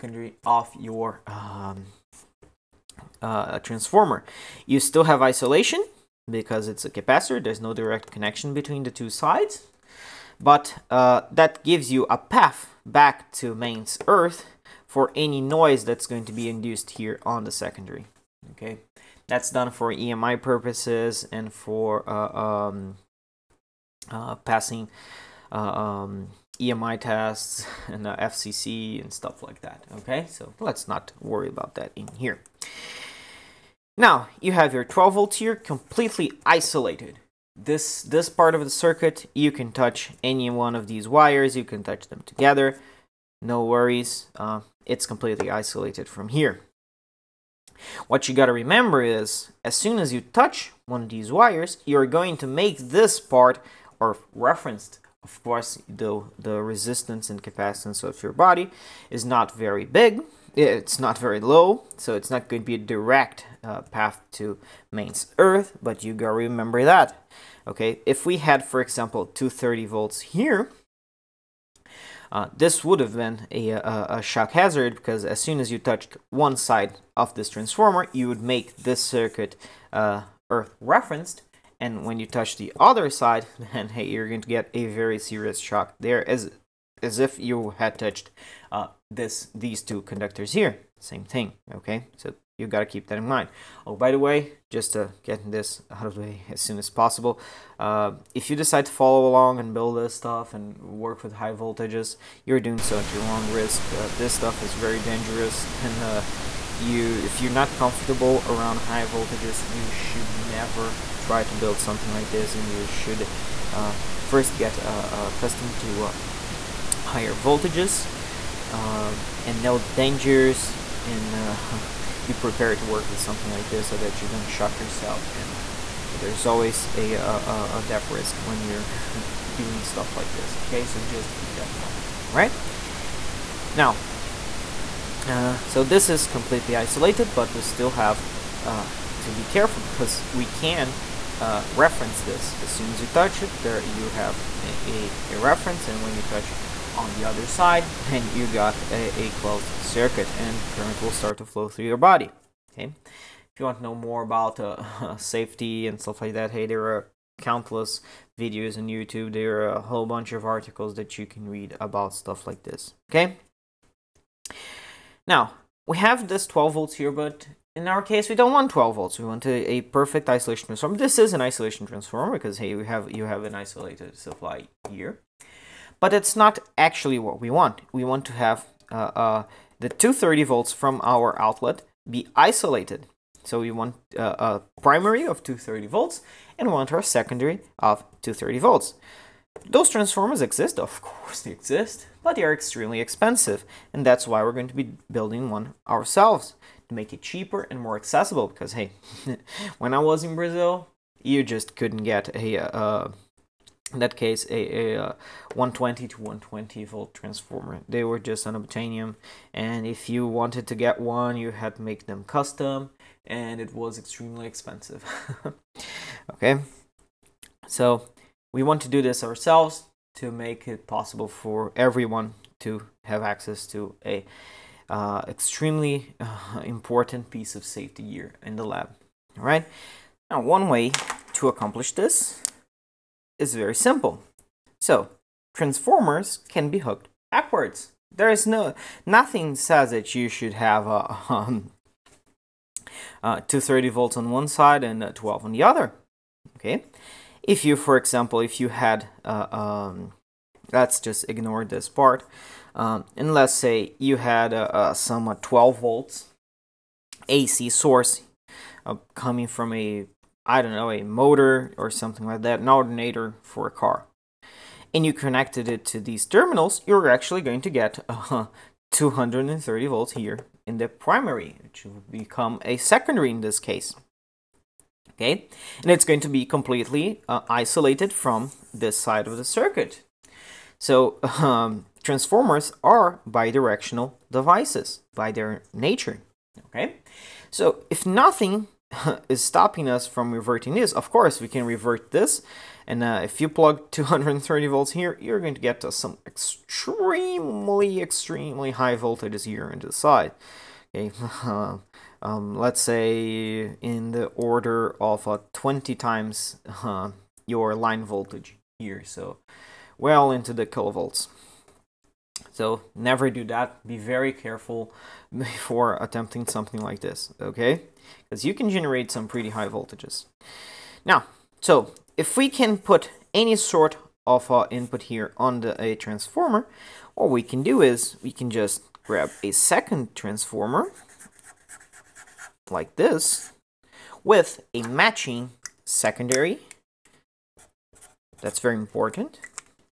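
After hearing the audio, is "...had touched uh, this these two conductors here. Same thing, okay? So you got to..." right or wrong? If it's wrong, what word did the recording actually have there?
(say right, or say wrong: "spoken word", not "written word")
right.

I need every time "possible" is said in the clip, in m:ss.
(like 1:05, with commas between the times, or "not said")
1:36, 3:40.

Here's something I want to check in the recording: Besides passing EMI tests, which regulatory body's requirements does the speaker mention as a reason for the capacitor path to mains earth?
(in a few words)
FCC.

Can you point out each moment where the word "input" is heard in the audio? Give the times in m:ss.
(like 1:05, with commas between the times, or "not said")
5:24.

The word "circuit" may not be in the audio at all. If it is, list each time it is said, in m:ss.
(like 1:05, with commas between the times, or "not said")
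0:38, 1:19, 2:29, 4:39.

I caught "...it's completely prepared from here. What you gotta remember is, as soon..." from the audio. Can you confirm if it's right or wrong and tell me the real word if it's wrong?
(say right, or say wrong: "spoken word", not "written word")
wrong: "isolated", not "prepared".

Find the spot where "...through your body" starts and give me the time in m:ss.
2:31.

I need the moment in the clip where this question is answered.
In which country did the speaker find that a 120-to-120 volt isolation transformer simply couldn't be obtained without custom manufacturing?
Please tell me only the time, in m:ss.
3:20.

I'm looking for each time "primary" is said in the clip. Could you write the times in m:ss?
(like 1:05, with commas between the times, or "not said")
3:04, 4:30.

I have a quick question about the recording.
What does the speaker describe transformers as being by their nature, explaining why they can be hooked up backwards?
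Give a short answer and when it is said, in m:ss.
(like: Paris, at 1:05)
Bidirectional devices, at 4:43.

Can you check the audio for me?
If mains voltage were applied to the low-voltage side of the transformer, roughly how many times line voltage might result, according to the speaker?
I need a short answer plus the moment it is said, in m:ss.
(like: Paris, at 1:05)
20 times, at 5:05.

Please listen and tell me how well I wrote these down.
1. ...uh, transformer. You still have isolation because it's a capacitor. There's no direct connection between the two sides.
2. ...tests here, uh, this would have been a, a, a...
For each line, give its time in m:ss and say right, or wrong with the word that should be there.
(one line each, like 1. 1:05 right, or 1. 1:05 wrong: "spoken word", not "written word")
1. 0:03 right
2. 1:09 wrong: "volts", not "tests".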